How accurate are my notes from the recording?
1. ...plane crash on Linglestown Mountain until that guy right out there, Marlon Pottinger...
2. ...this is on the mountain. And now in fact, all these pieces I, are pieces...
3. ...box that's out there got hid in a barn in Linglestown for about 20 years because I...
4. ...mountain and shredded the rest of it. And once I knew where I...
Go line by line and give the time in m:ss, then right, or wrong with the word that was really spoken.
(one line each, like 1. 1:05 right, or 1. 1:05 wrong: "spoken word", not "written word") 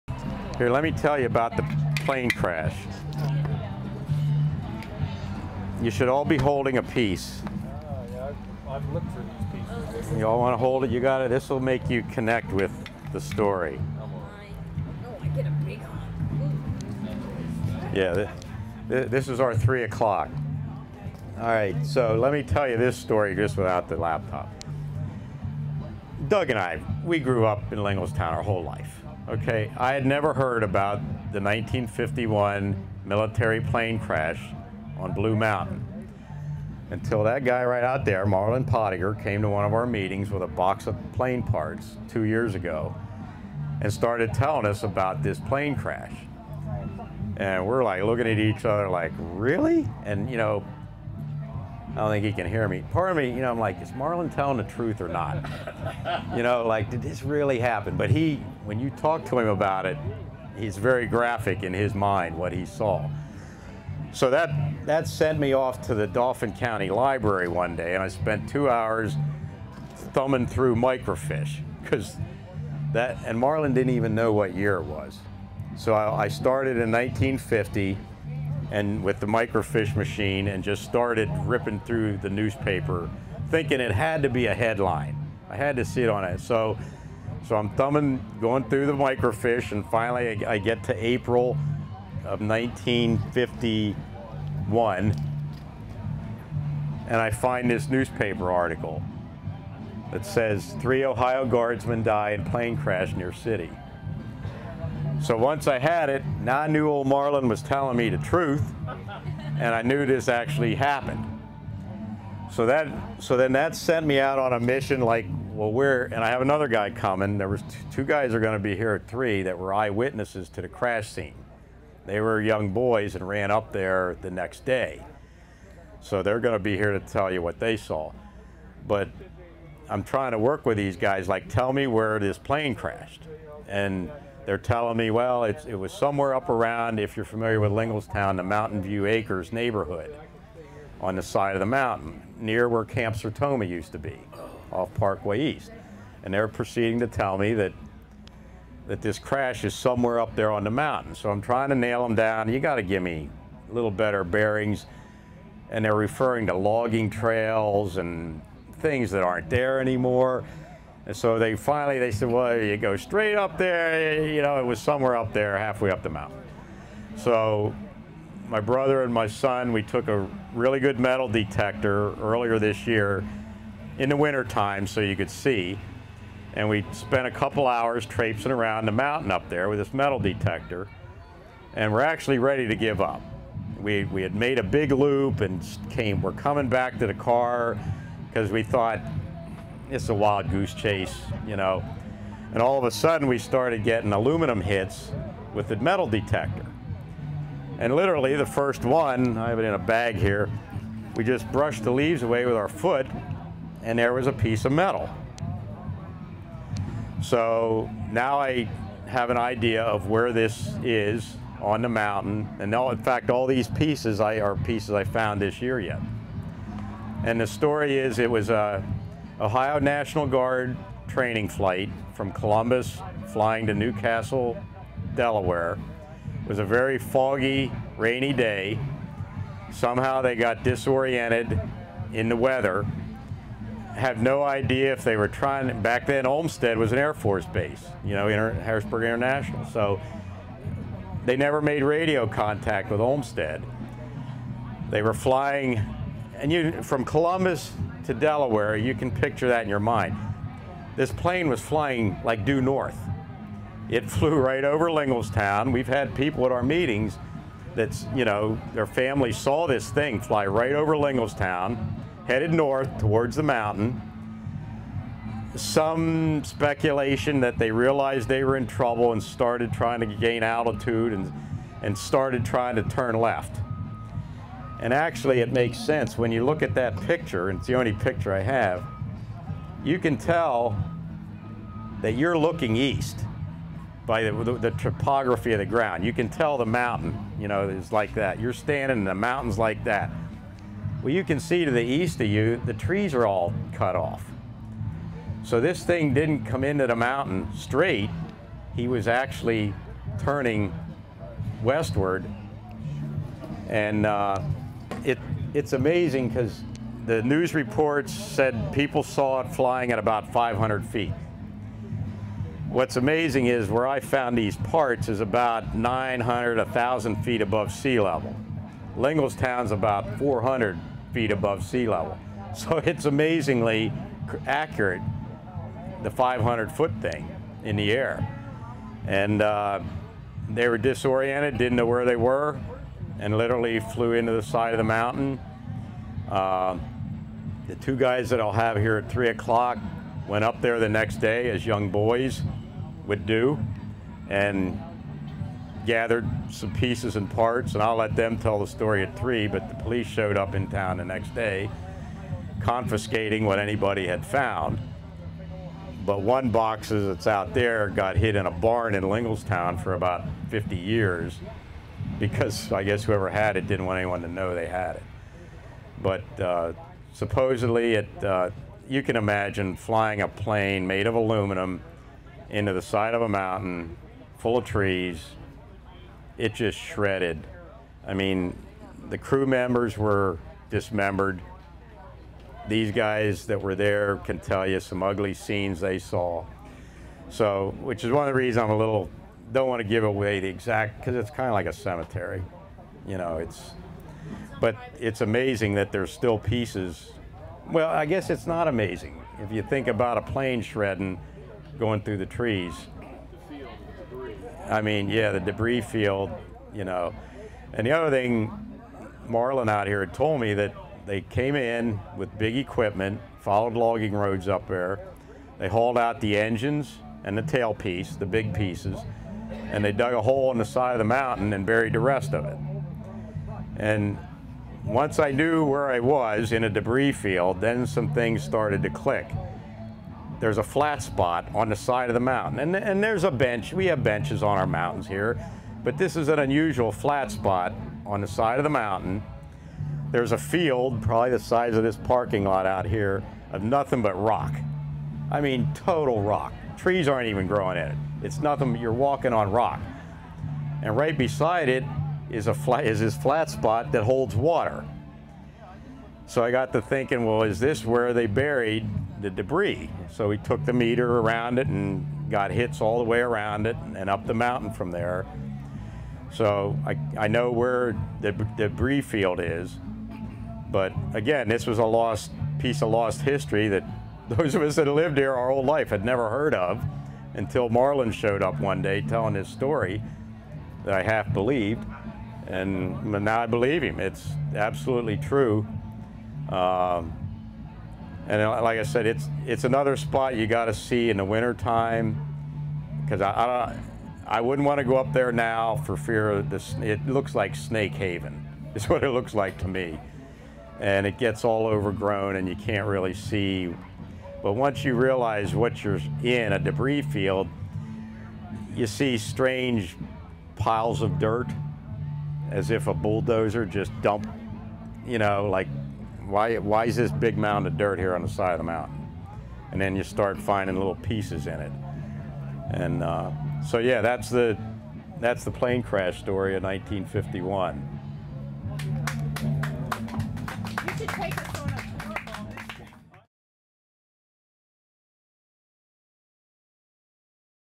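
1. 0:33 wrong: "Blue", not "Linglestown"
2. 3:30 right
3. 5:56 wrong: "50", not "20"
4. 7:01 wrong: "buried", not "shredded".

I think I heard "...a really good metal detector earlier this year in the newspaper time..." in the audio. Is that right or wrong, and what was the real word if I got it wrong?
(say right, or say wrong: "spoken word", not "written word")
wrong: "winter", not "newspaper".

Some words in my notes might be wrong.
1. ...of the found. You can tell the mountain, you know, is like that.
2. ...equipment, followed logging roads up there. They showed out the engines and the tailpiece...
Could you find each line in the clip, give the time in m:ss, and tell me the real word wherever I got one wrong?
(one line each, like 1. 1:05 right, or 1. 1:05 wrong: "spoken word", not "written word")
1. 4:45 wrong: "ground", not "found"
2. 6:52 wrong: "hauled", not "showed".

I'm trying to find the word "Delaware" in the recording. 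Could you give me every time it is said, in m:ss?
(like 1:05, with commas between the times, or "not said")
3:45, 4:08.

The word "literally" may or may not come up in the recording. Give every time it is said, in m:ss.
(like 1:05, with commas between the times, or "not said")
3:17, 5:33.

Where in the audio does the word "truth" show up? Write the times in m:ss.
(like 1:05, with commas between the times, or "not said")
0:54, 1:48.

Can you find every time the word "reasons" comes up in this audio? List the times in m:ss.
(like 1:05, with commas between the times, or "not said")
6:28.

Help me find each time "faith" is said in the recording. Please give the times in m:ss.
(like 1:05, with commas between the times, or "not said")
not said.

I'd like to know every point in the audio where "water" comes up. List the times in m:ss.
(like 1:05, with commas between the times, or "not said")
7:34.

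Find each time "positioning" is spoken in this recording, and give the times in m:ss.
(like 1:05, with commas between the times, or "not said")
not said.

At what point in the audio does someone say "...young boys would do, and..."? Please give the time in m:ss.
5:41.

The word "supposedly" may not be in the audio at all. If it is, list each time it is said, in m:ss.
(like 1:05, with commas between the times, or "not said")
6:07.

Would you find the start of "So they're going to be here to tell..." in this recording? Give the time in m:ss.
2:05.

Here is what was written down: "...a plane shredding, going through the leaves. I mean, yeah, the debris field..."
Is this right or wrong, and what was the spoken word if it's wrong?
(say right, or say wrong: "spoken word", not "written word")
wrong: "trees", not "leaves".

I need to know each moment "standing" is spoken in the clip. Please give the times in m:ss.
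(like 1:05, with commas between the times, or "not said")
4:48.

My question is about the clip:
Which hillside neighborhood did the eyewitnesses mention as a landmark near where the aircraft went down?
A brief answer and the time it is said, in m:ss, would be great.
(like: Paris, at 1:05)
Mountain View Acres, at 2:18.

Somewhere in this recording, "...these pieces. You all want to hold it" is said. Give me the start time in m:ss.
0:09.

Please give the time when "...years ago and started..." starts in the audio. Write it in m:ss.
0:42.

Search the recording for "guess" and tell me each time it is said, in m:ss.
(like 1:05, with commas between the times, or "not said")
6:02, 6:38.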